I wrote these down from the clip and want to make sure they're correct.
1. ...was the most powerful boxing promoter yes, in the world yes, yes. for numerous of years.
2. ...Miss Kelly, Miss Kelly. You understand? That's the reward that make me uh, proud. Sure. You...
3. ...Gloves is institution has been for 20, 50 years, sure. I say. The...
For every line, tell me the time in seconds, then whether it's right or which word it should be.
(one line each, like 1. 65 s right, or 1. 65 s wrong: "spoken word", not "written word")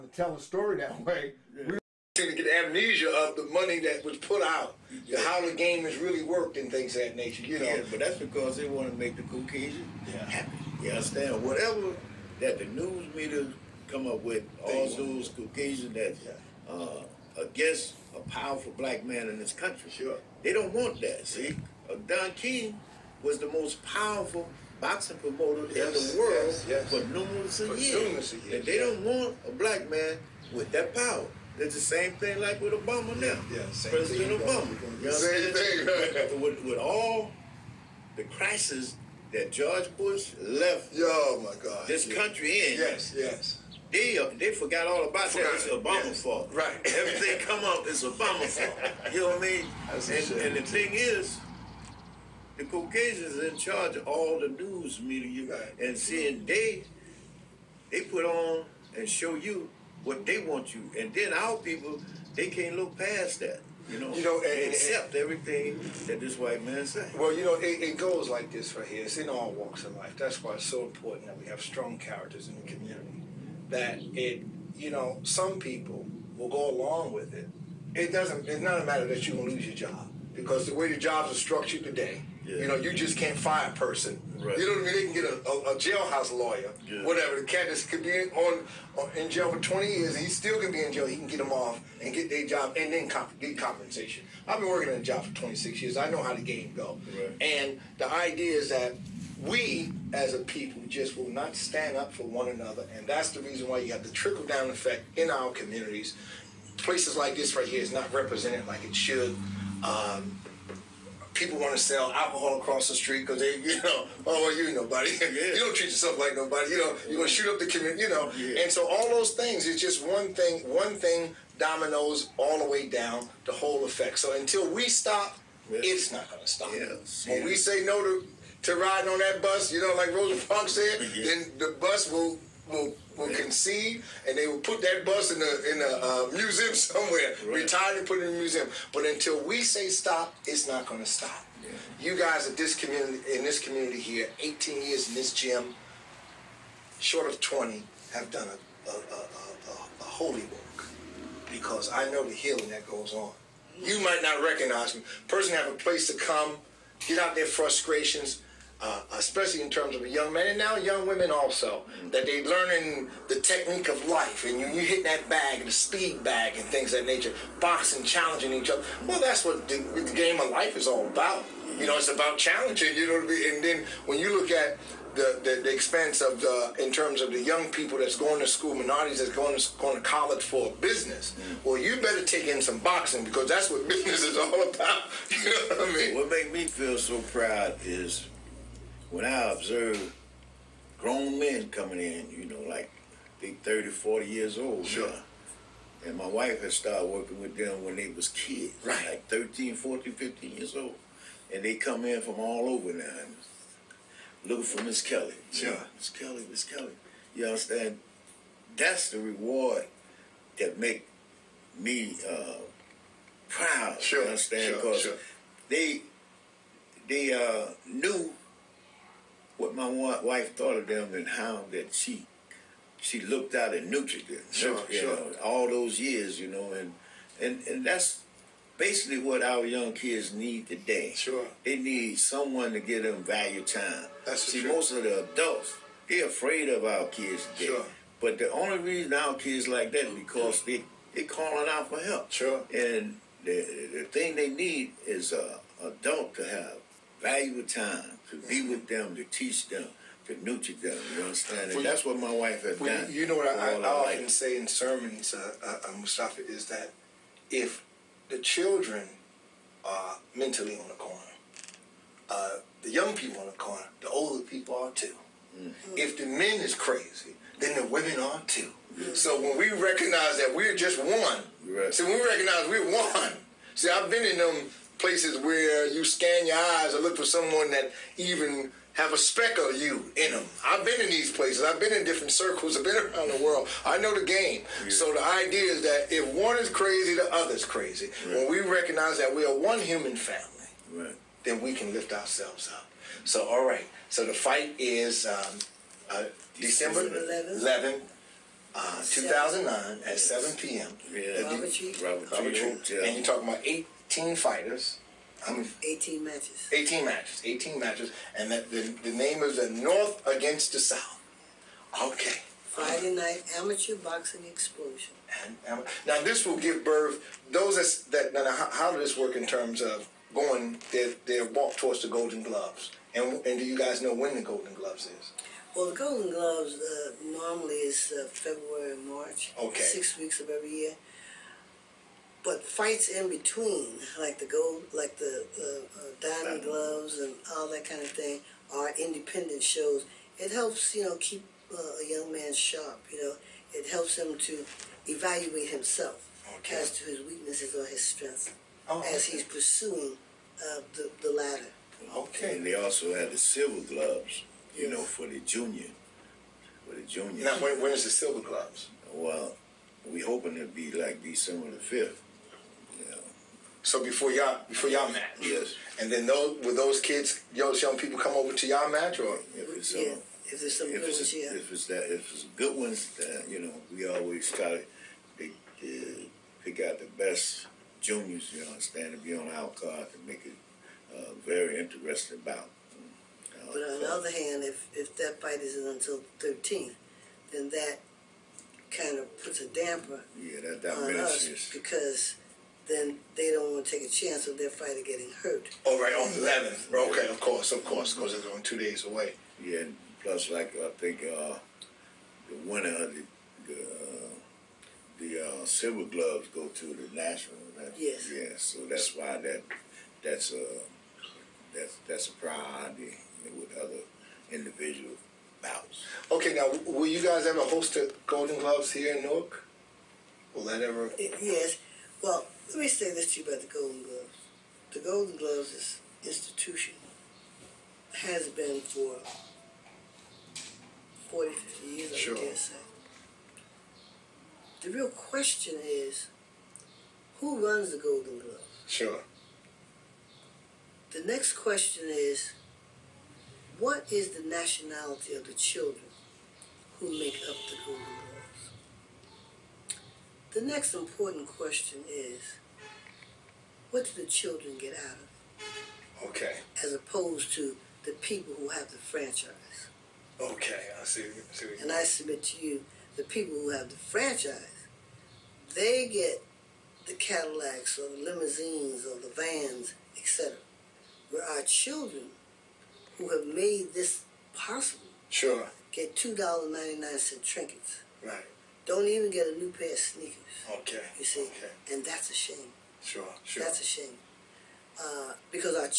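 1. 23 s right
2. 205 s right
3. 425 s wrong: "40", not "20".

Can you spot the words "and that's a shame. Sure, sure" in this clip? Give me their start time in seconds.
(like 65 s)
481 s.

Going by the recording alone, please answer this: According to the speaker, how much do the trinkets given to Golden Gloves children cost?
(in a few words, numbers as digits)
$2.99.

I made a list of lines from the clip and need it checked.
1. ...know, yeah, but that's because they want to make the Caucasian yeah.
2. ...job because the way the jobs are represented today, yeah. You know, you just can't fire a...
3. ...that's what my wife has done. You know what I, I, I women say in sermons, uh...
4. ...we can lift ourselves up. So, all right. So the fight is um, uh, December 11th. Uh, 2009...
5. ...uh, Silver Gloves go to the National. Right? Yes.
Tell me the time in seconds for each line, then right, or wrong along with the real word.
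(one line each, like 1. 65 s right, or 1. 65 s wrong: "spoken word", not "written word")
1. 7 s right
2. 79 s wrong: "structured", not "represented"
3. 251 s wrong: "often", not "women"
4. 291 s right
5. 405 s right.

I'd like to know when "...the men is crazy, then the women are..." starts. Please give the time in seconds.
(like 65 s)
266 s.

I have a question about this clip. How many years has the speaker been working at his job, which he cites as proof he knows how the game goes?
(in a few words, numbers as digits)
26.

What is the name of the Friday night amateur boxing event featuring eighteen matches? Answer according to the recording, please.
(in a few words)
The North Against the South.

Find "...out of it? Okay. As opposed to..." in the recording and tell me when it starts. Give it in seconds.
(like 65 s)
454 s.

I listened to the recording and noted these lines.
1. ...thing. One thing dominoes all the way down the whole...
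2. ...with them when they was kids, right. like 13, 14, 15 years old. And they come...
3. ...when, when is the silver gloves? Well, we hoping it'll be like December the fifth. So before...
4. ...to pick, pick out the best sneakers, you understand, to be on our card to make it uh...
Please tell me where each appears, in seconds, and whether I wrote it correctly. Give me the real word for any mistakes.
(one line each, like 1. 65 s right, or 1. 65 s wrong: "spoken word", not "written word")
1. 120 s right
2. 197 s right
3. 357 s right
4. 374 s wrong: "juniors", not "sneakers".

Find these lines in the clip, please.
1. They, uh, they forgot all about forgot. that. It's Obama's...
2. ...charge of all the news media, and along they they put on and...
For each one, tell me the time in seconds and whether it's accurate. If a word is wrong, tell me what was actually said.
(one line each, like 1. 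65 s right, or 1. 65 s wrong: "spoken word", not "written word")
1. 43 s right
2. 53 s wrong: "seeing", not "along".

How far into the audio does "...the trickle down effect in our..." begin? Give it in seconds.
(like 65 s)
104 s.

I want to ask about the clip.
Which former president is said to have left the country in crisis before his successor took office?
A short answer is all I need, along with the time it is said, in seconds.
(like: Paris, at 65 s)
George Bush, at 39 s.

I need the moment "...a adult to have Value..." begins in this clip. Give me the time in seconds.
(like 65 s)
245 s.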